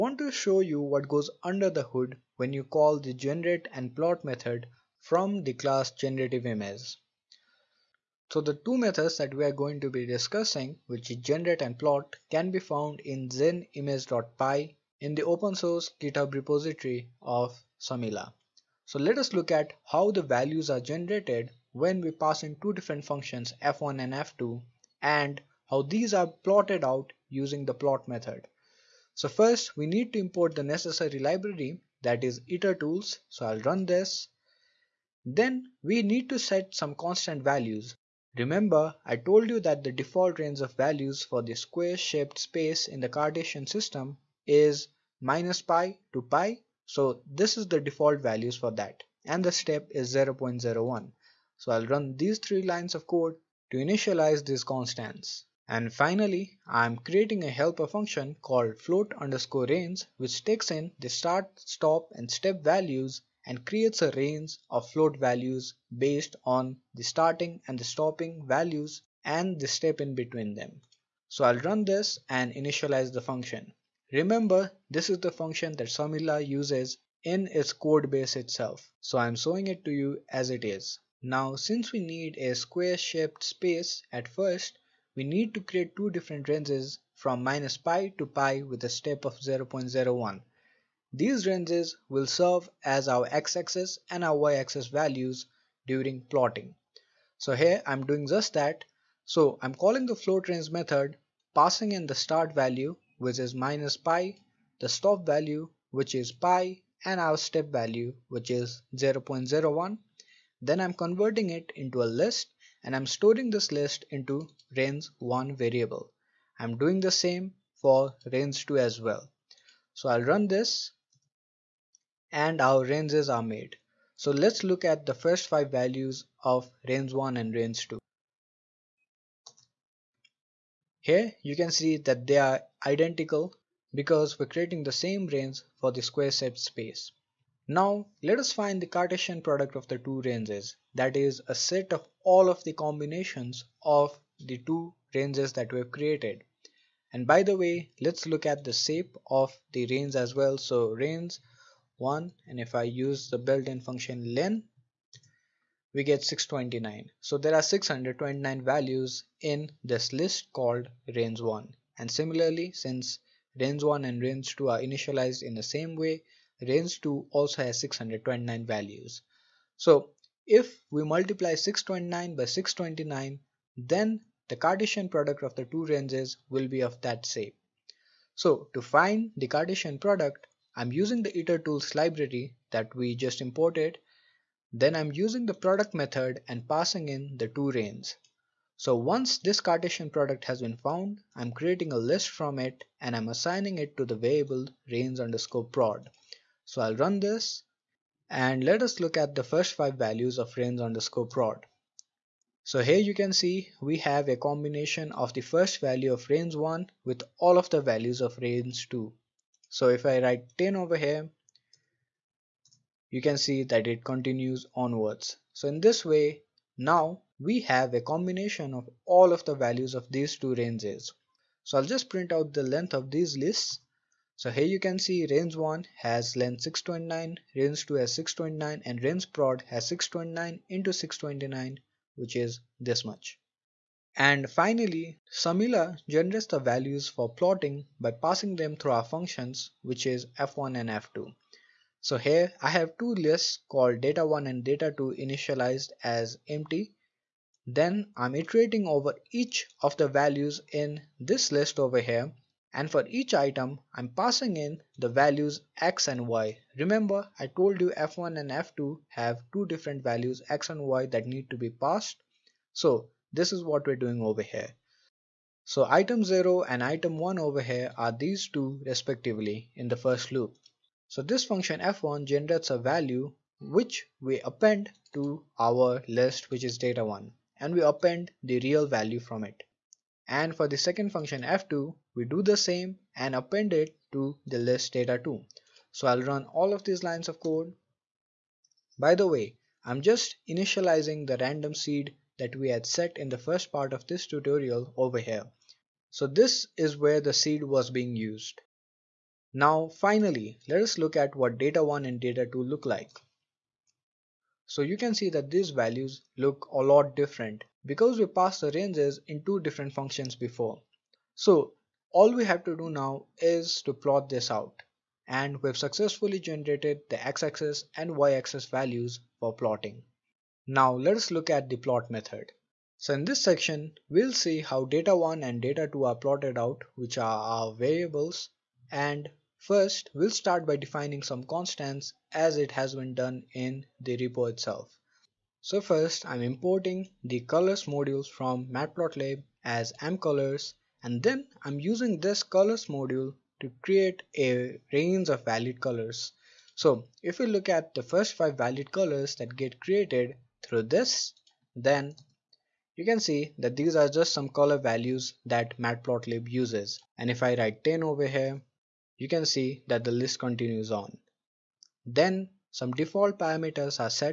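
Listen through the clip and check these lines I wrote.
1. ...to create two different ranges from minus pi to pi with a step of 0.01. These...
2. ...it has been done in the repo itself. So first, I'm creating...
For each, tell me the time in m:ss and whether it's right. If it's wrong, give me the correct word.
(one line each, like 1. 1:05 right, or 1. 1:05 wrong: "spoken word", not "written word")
1. 1:25 right
2. 5:32 wrong: "importing", not "creating".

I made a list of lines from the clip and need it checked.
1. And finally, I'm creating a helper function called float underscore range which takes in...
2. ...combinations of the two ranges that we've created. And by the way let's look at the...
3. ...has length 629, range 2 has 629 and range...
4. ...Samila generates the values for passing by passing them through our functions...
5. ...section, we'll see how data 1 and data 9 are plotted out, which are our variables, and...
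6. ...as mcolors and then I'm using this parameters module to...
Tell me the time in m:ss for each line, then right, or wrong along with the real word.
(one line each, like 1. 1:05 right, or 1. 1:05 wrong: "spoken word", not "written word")
1. 0:55 right
2. 2:22 right
3. 3:45 right
4. 3:55 wrong: "plotting", not "passing"
5. 5:23 wrong: "2", not "9"
6. 5:39 wrong: "colors", not "parameters".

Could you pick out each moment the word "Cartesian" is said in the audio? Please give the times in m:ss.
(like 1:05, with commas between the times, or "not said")
0:43, 2:18, 2:54, 2:59, 3:09.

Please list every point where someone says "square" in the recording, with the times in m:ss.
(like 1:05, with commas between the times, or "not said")
0:41, 1:22, 2:16.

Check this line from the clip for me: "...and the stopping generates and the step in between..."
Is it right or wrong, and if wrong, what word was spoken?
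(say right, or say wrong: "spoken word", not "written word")
wrong: "values", not "generates".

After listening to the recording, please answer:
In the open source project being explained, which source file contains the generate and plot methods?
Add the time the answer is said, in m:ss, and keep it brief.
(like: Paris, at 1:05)
genimage.py, at 0:13.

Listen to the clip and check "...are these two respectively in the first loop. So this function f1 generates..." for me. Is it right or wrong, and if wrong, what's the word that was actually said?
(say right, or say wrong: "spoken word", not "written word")
right.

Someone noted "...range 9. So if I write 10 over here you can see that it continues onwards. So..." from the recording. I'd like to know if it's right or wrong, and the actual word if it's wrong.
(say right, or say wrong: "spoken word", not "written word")
wrong: "2", not "9".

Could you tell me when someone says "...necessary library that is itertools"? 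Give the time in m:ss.
0:30.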